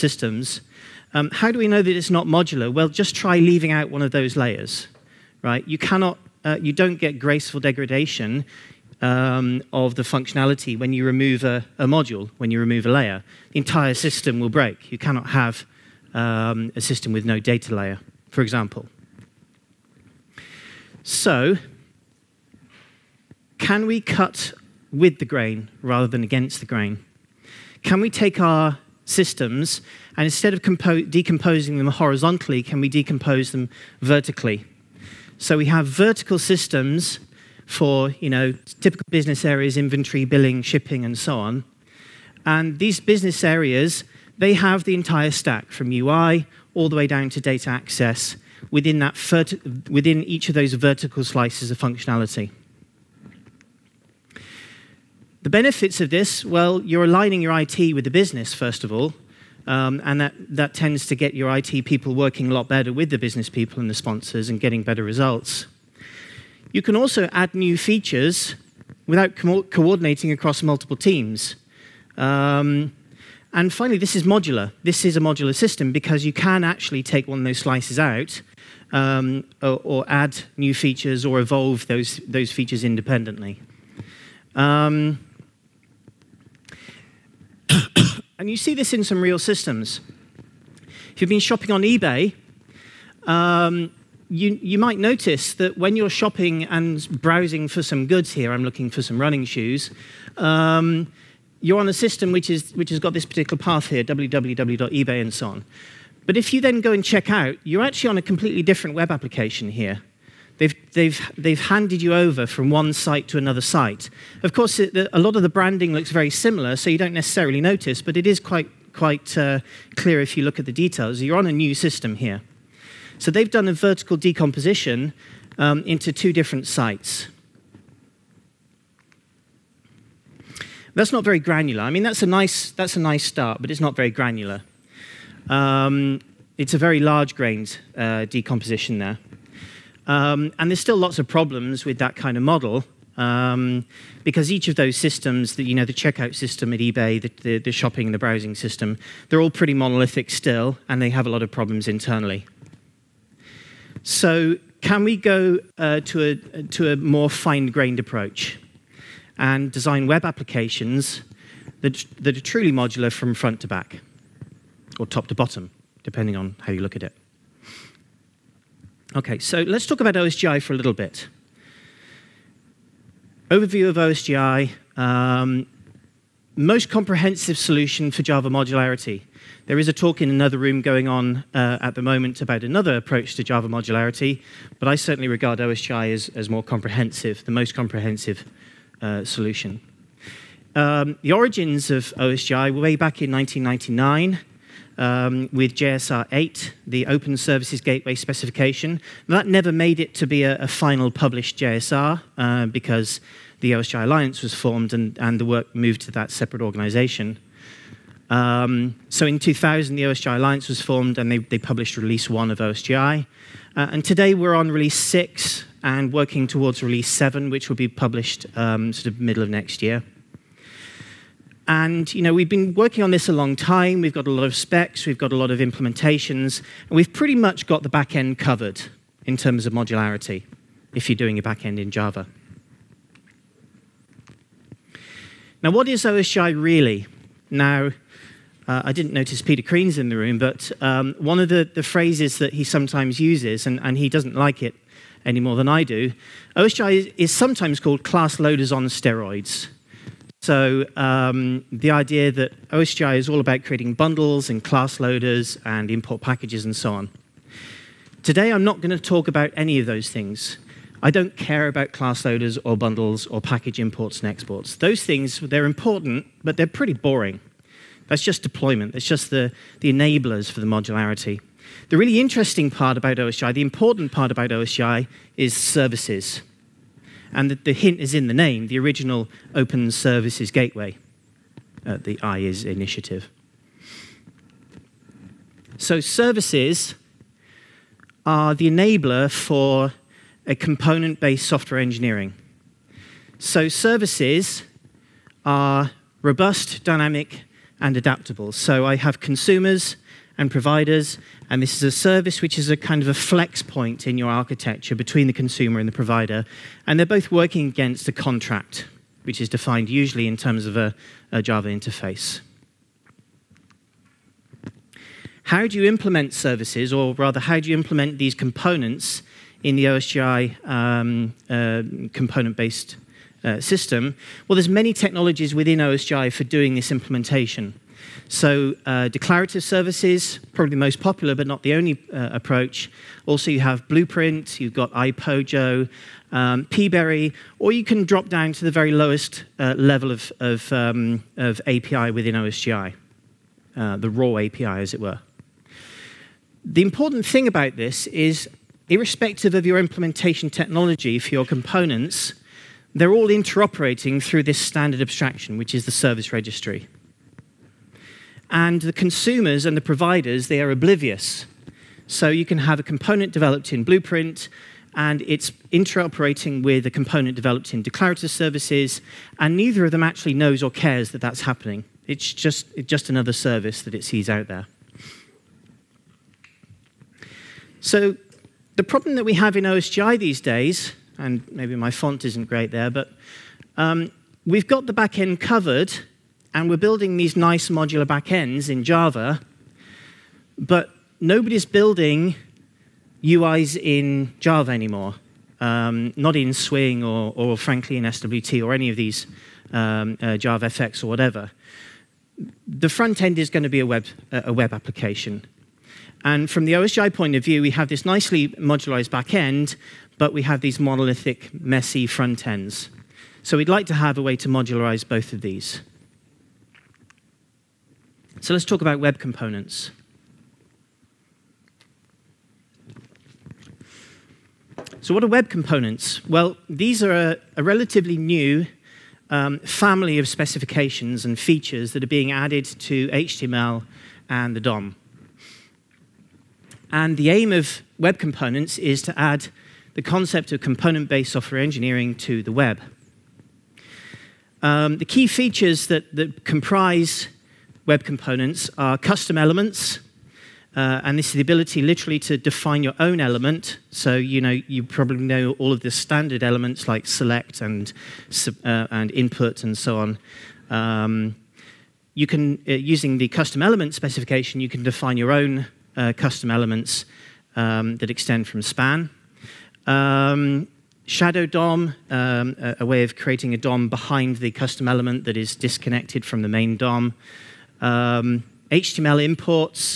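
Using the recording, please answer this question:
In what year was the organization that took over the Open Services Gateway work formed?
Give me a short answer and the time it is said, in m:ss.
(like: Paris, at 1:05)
2000, at 3:29.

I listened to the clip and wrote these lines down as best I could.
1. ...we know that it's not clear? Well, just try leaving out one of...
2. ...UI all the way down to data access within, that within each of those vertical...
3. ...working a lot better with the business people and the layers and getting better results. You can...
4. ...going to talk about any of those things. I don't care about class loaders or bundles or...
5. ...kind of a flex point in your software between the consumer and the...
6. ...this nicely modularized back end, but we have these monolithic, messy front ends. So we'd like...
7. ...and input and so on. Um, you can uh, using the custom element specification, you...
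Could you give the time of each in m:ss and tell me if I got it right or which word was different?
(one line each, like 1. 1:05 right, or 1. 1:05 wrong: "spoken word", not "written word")
1. 0:01 wrong: "modular", not "clear"
2. 0:45 right
3. 1:02 wrong: "sponsors", not "layers"
4. 4:18 right
5. 5:02 wrong: "architecture", not "software"
6. 6:47 right
7. 7:38 right.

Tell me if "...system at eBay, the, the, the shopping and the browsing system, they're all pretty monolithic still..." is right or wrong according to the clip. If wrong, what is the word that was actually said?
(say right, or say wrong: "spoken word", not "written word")
right.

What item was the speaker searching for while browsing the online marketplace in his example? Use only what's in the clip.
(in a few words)
running shoes.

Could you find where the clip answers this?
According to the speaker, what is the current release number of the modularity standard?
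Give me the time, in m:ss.
3:34.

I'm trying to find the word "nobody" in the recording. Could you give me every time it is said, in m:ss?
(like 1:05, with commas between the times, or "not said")
6:31.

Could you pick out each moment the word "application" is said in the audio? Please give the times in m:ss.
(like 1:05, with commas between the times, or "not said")
1:49, 2:40, 6:44.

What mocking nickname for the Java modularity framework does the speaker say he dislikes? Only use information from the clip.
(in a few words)
class loaders on steroids.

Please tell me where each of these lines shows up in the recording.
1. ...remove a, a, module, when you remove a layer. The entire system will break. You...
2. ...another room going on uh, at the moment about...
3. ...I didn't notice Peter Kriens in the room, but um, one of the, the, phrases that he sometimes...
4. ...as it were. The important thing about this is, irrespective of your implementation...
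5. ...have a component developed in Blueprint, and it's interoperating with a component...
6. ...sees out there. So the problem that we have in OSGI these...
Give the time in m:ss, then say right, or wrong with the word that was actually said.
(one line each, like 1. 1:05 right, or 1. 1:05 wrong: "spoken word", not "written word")
1. 0:11 right
2. 3:00 right
3. 3:58 right
4. 5:44 right
5. 6:02 right
6. 6:14 right.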